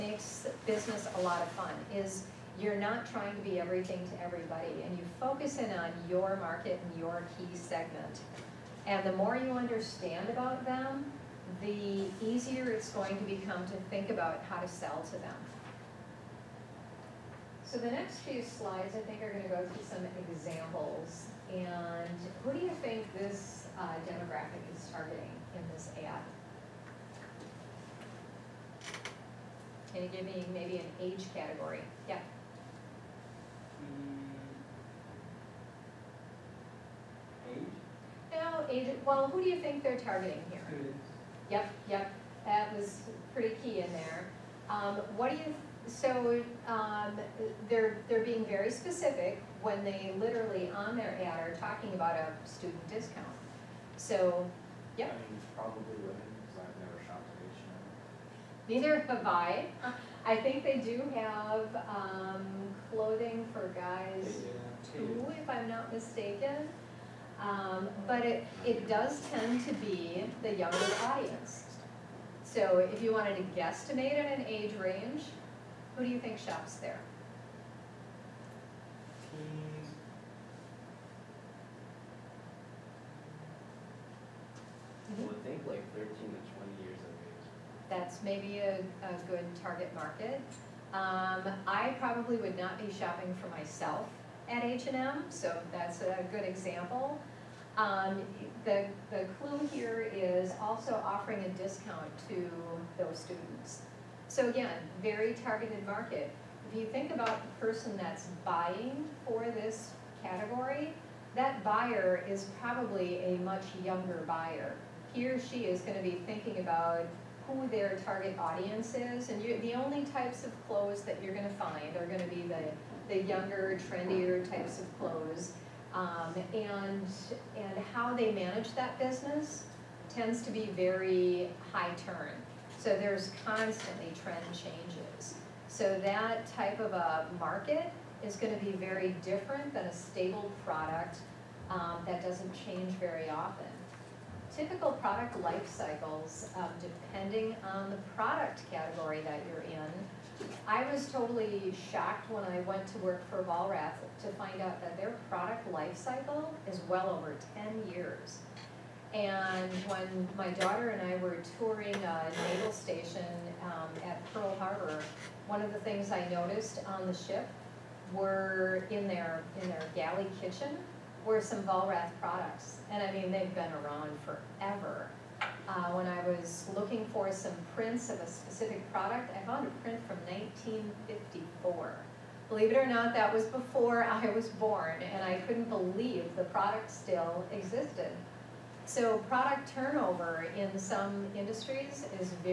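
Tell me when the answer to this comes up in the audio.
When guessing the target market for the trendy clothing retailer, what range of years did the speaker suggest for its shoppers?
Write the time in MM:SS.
01:25.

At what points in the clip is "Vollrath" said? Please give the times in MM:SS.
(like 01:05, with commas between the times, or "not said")
02:33, 02:51.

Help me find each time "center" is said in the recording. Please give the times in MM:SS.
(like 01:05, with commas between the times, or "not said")
not said.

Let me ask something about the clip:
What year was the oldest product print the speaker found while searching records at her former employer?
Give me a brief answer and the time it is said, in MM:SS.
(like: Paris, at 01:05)
1954, at 03:00.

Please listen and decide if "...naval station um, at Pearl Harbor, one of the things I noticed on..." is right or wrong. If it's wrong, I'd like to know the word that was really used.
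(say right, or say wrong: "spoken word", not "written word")
right.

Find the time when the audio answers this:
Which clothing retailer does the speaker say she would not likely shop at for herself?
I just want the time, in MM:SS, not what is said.
01:34.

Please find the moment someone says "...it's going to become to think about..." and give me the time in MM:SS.
00:12.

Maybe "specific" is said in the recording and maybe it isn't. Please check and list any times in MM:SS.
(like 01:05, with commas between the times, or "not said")
00:48, 02:58.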